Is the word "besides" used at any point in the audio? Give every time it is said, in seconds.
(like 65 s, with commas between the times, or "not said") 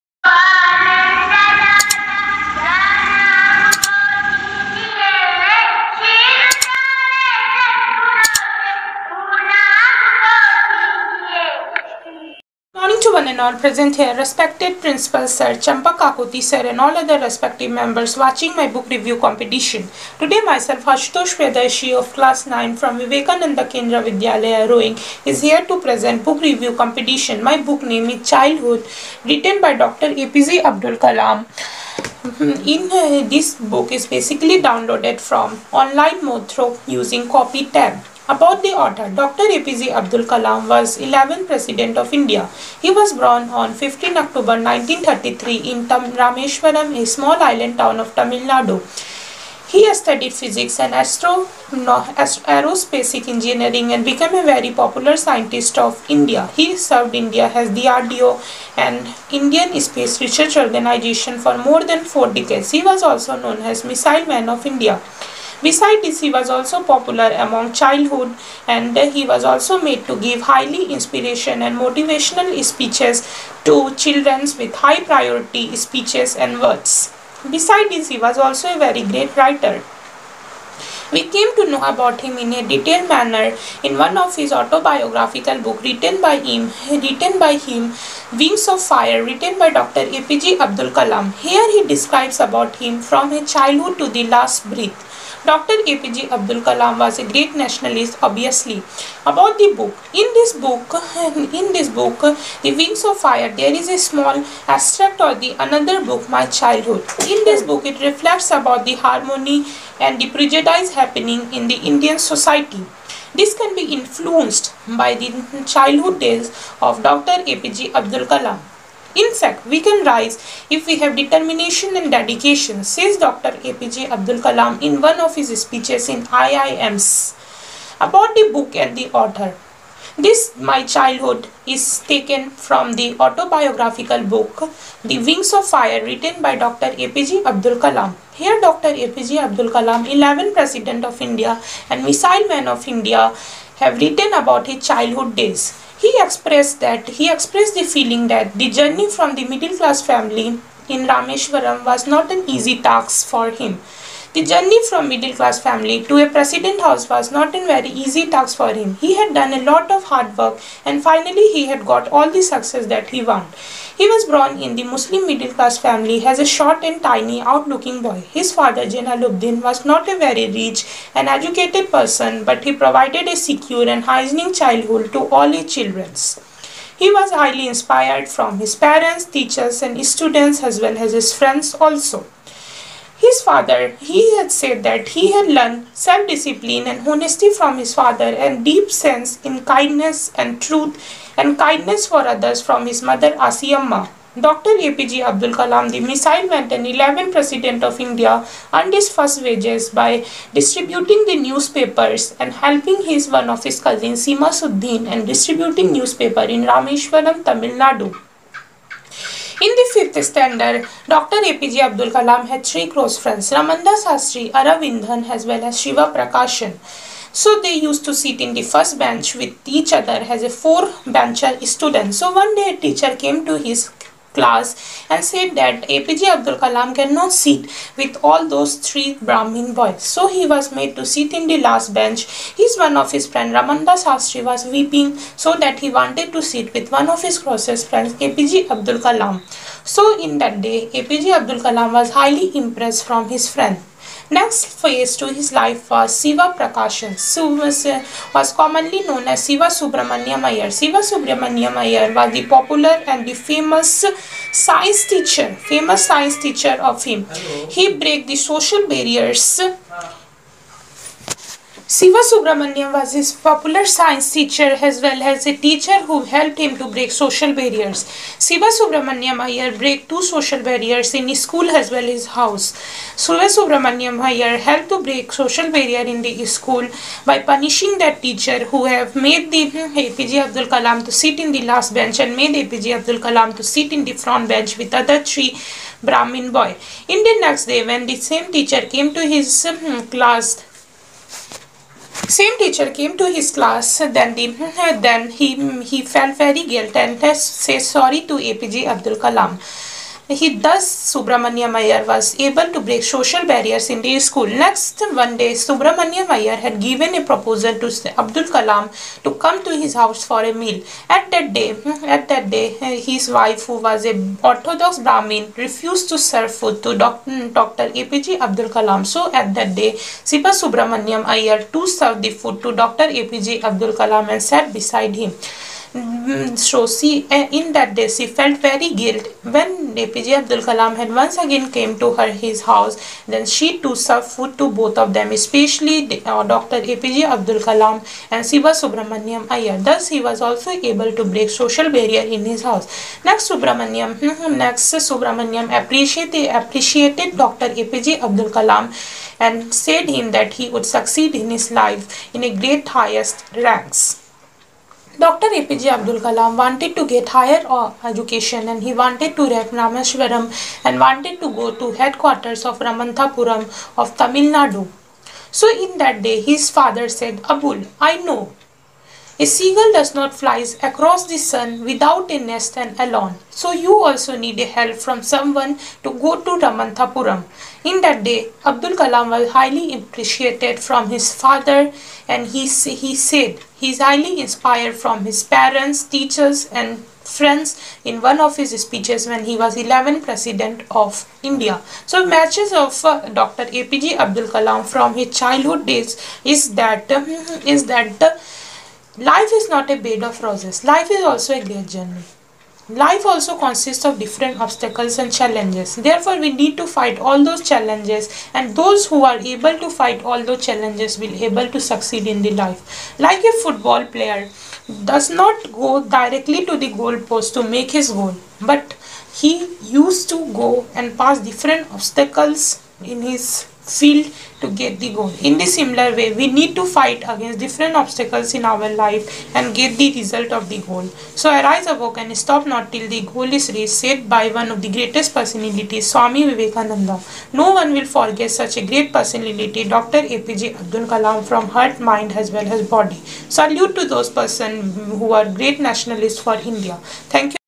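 65 s, 77 s, 324 s.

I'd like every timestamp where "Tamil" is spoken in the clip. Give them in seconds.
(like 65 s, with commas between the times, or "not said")
48 s, 207 s, 364 s.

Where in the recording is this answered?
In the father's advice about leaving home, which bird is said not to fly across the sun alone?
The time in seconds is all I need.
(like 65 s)
369 s.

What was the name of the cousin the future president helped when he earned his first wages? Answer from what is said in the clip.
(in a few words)
Samsuddin.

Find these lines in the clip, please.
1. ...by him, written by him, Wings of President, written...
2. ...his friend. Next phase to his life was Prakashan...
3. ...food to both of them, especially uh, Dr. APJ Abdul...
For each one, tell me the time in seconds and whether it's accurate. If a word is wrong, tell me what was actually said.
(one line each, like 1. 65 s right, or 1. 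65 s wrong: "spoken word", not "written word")
1. 86 s wrong: "Fire", not "President"
2. 243 s wrong: "Siva", not "Prakashan"
3. 334 s right.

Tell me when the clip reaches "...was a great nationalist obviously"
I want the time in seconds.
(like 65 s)
96 s.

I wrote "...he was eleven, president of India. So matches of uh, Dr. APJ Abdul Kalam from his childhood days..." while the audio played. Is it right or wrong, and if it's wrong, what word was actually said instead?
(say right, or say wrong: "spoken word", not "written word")
right.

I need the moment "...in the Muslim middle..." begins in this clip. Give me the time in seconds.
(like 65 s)
164 s.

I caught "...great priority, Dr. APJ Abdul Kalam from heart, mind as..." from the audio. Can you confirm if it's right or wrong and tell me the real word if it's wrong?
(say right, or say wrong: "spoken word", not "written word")
wrong: "personality", not "priority".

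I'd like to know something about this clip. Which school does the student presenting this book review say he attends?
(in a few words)
Vivekananda Kendra Vidyalaya Roing.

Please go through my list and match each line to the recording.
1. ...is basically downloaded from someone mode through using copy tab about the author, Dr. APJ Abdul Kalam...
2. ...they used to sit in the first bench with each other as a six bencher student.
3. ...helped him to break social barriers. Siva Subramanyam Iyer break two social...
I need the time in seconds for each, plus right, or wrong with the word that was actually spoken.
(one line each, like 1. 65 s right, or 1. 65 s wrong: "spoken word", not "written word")
1. 33 s wrong: "online", not "someone"
2. 217 s wrong: "four", not "six"
3. 266 s right.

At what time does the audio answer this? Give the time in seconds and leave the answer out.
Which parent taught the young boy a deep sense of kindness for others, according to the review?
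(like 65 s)
193 s.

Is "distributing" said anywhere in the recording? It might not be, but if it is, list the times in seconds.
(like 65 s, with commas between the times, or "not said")
200 s, 205 s.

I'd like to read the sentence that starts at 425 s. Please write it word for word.
In the similar way, we need to fight against different obstacles in our life and get the result of the goal.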